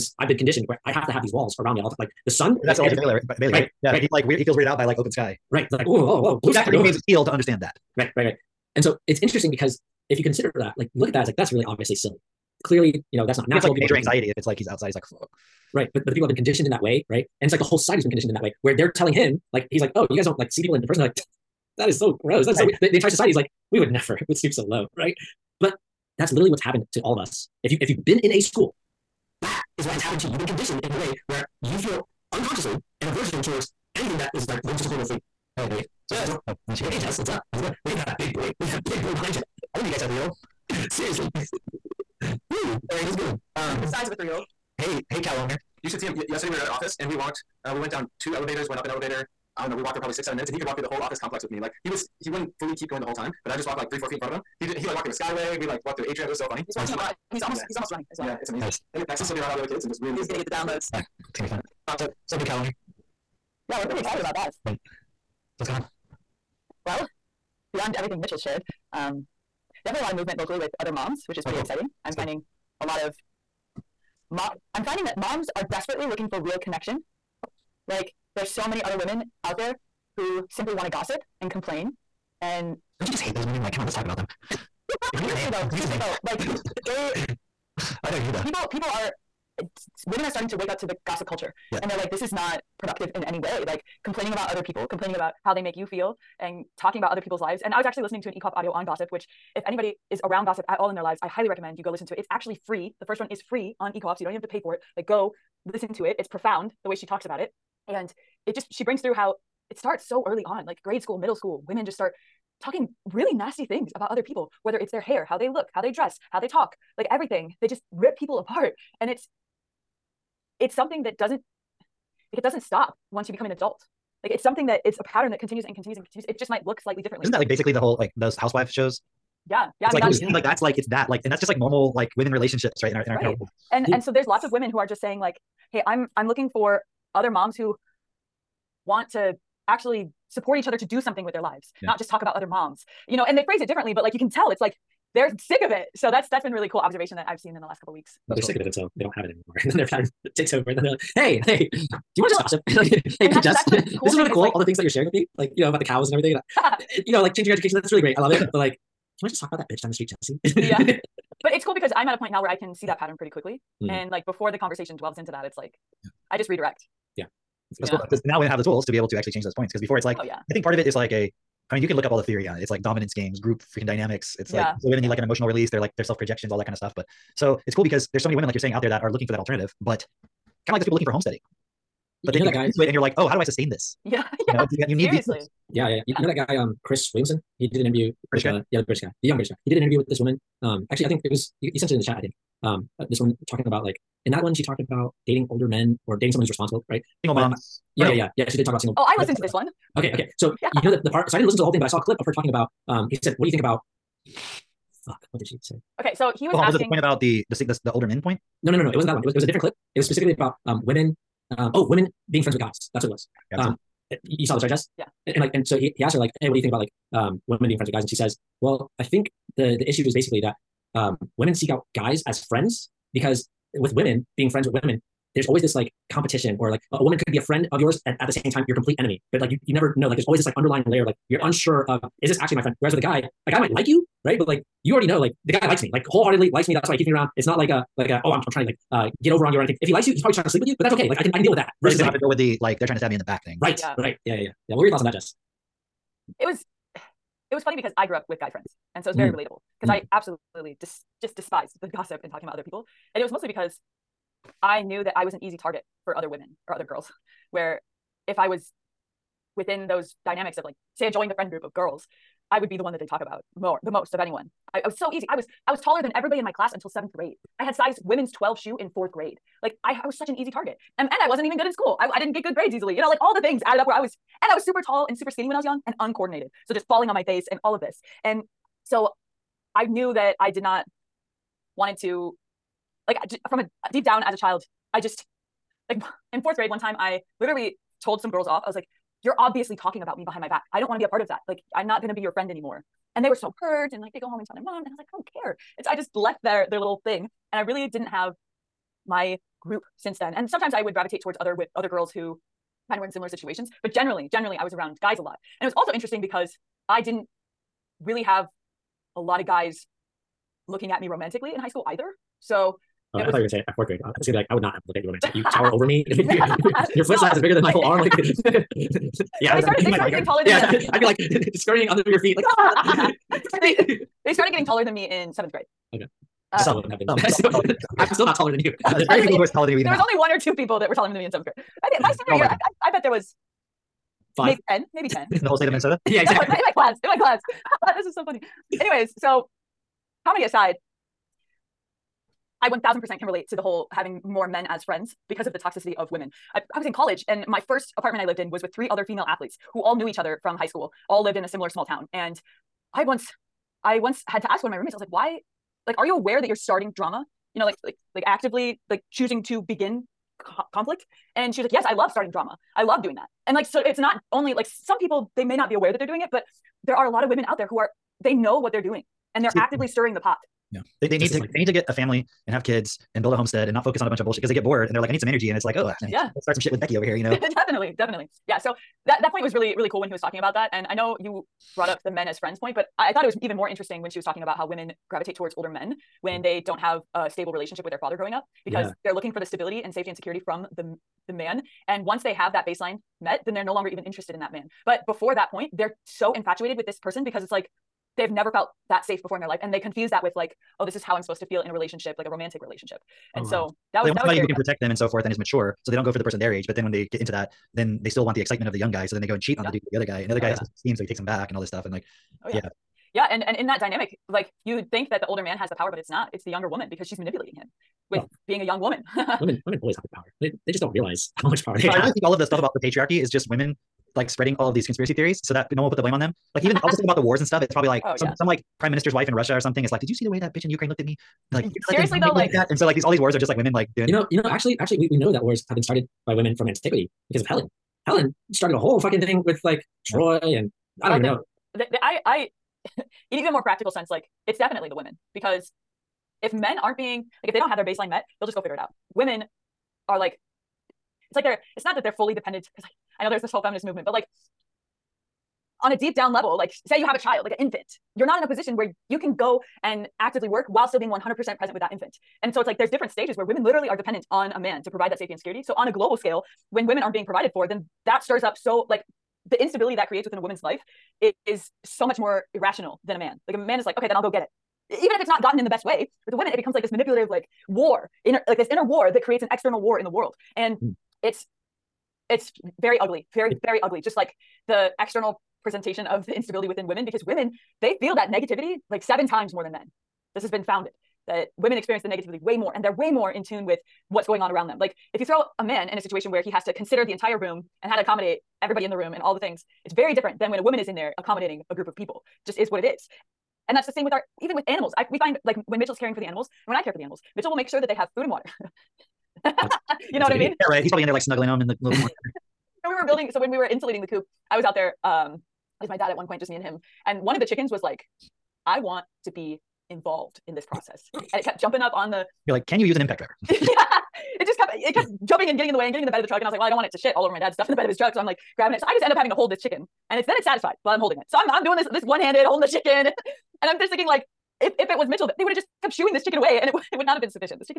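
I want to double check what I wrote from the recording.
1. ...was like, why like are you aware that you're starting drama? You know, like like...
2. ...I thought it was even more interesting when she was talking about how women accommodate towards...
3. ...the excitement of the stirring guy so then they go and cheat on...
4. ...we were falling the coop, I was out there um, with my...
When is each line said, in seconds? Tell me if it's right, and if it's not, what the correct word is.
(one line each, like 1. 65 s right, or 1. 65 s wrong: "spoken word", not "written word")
1. 354 s right
2. 383 s wrong: "gravitate", not "accommodate"
3. 408 s wrong: "young", not "stirring"
4. 513 s wrong: "insulating", not "falling".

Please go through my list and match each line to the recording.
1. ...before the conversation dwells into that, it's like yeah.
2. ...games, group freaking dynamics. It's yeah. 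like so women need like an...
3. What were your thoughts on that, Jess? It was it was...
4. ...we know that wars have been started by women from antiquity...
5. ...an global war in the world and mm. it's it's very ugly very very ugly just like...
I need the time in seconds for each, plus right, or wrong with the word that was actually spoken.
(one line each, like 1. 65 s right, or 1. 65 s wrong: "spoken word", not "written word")
1. 164 s right
2. 173 s right
3. 244 s right
4. 435 s right
5. 479 s wrong: "external", not "global".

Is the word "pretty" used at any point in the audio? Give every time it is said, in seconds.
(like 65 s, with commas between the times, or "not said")
63 s, 71 s, 163 s.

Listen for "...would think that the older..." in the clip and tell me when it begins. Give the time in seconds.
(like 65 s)
414 s.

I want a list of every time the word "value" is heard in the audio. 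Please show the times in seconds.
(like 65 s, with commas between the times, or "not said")
not said.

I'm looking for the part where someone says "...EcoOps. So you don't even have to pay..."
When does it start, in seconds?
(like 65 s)
103 s.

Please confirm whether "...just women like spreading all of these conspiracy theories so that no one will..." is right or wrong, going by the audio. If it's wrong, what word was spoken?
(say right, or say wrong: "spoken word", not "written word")
right.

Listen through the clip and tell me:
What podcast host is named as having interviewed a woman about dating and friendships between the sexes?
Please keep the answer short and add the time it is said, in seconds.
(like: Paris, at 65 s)
Chris Williamson, at 186 s.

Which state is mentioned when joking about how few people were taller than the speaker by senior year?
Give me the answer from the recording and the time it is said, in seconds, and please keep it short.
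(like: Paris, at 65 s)
Minnesota, at 335 s.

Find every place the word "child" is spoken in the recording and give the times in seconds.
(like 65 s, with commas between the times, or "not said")
284 s, 457 s.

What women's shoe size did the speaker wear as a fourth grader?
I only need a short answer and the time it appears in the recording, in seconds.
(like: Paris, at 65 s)
12, at 268 s.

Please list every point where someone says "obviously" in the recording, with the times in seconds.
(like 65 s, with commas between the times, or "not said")
11 s, 289 s.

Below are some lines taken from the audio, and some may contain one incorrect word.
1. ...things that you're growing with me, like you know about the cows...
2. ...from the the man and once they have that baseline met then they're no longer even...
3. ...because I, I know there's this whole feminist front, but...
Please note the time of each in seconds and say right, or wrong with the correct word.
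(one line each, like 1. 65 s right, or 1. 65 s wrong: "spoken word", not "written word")
1. 154 s wrong: "sharing", not "growing"
2. 390 s right
3. 452 s wrong: "movement", not "front".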